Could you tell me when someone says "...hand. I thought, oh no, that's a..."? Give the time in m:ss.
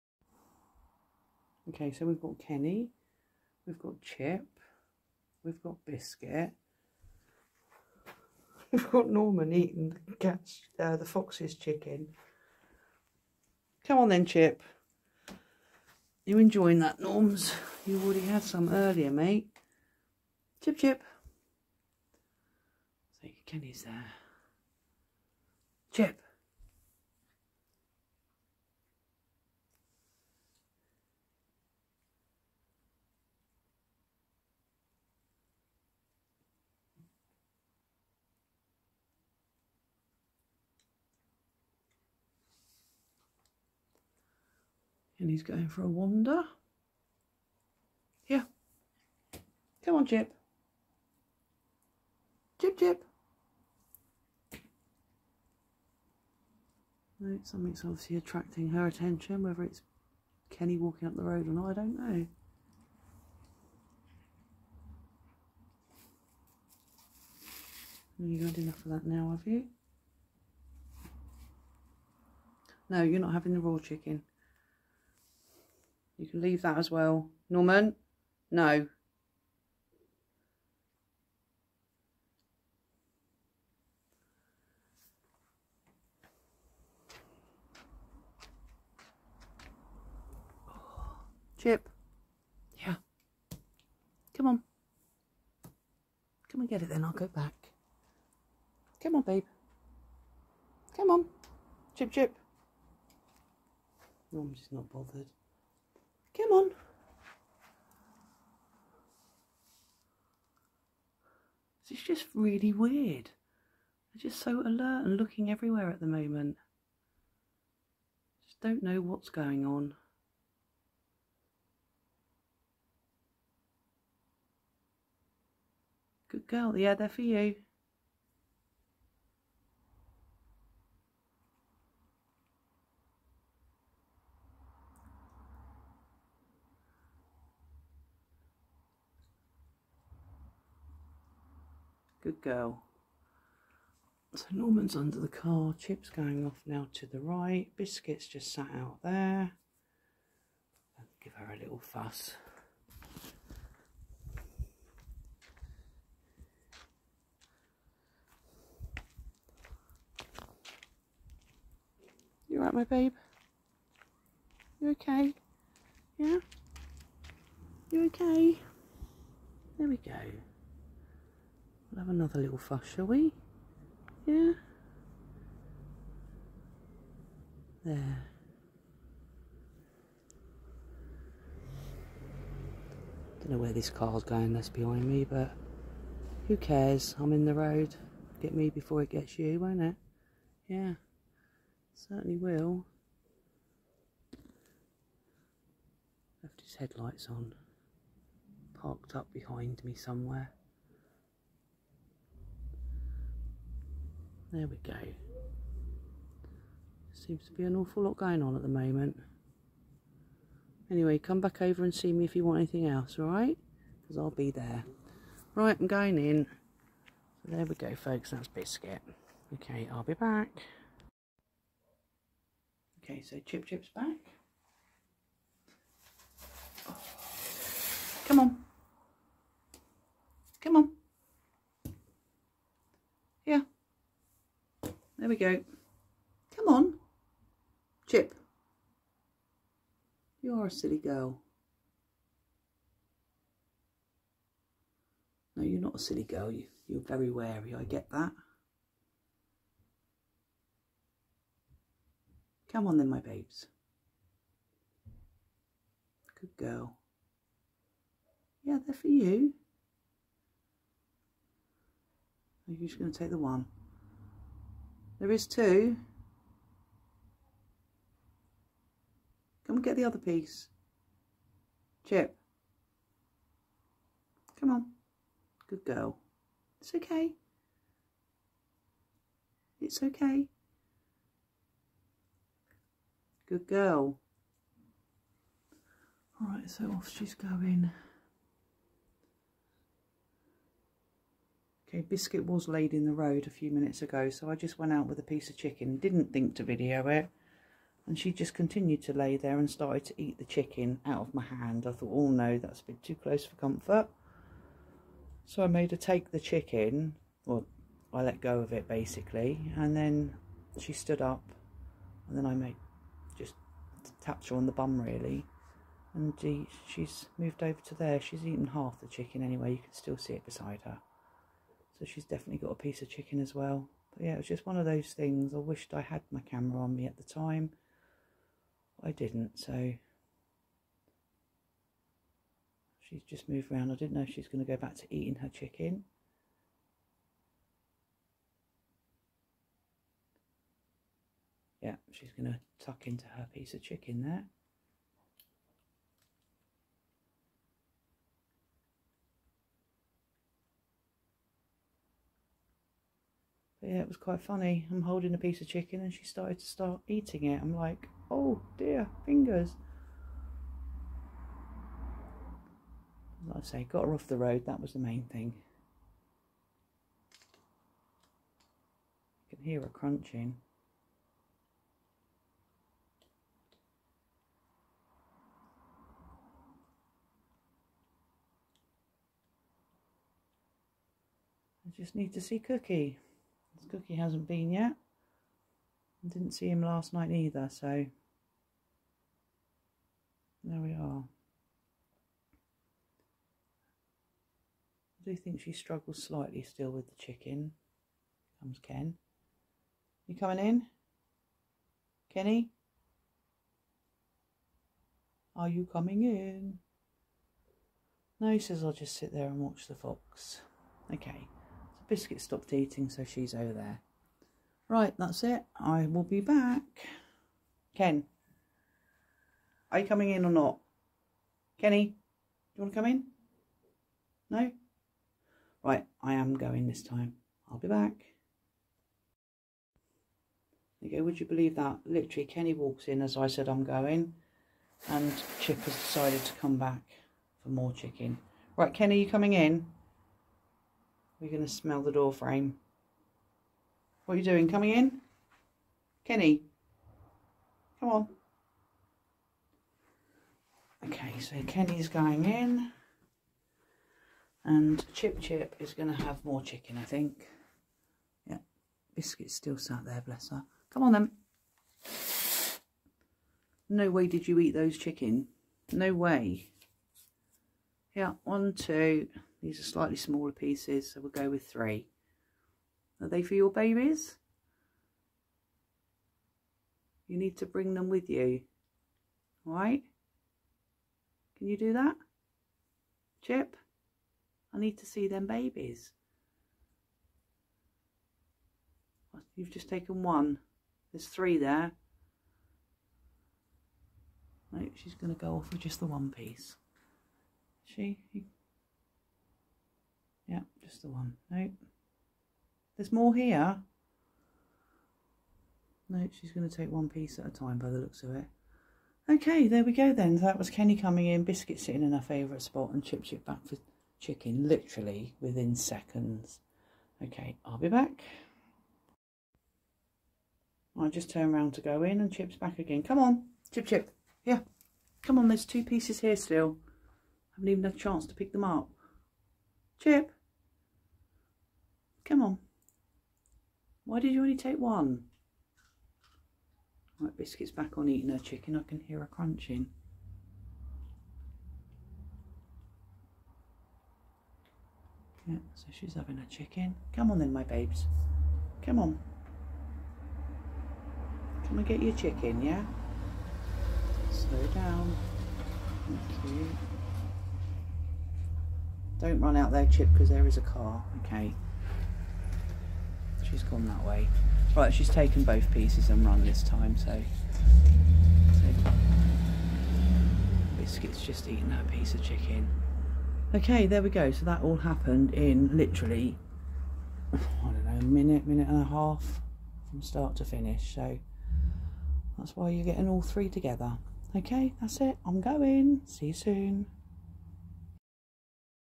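5:01.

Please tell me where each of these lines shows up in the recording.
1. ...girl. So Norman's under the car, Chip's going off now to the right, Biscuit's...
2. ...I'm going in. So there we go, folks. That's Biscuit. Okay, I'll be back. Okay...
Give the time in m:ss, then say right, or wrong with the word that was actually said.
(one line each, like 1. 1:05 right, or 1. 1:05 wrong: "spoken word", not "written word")
1. 2:22 right
2. 3:35 right.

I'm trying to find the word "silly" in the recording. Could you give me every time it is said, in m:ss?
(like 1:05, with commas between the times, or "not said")
4:00, 4:05.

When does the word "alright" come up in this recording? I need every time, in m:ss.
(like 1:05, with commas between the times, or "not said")
2:42, 3:33, 4:46.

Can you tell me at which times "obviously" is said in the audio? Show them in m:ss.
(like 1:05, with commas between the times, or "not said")
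0:57.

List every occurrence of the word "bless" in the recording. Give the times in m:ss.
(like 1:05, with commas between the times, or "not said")
7:40.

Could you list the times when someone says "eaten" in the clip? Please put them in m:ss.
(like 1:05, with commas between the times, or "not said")
5:18, 9:31.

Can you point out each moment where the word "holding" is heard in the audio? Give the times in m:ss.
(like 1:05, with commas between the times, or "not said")
5:55.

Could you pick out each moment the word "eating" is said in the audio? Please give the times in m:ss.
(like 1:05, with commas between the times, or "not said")
0:09, 5:35, 5:57, 6:52, 8:58.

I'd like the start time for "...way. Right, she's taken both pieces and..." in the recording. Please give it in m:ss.
9:24.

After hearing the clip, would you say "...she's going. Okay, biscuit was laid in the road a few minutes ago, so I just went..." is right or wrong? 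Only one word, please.
right.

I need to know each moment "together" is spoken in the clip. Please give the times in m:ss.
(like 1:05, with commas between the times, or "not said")
9:43.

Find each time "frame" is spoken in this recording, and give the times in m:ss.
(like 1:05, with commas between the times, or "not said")
7:22.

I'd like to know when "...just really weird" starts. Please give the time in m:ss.
1:52.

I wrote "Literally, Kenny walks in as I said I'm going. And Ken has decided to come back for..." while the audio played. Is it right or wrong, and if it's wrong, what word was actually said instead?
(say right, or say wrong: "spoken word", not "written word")
wrong: "Chip", not "Ken".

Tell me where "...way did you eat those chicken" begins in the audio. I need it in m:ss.
7:44.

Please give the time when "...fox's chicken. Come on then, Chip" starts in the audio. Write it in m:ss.
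0:11.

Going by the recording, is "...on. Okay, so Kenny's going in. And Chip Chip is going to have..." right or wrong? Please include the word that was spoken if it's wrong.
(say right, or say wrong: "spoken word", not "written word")
right.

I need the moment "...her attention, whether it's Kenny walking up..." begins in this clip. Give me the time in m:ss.
0:58.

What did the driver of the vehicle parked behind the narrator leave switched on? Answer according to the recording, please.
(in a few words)
His headlights.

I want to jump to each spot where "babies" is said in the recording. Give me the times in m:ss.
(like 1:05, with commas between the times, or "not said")
7:53, 8:05.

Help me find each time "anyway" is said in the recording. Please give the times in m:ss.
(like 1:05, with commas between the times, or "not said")
3:30, 5:19.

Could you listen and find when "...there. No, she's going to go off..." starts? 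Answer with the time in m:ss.
8:11.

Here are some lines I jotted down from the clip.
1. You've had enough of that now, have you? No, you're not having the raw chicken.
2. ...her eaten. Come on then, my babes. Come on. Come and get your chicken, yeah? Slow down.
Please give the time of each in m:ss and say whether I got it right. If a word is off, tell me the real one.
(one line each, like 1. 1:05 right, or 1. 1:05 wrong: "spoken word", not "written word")
1. 1:08 right
2. 9:06 wrong: "chicken", not "eaten".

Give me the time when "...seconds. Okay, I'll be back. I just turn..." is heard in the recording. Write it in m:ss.
8:35.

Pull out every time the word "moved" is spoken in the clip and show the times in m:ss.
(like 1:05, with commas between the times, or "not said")
5:17, 5:33.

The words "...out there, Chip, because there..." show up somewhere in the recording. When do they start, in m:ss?
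9:19.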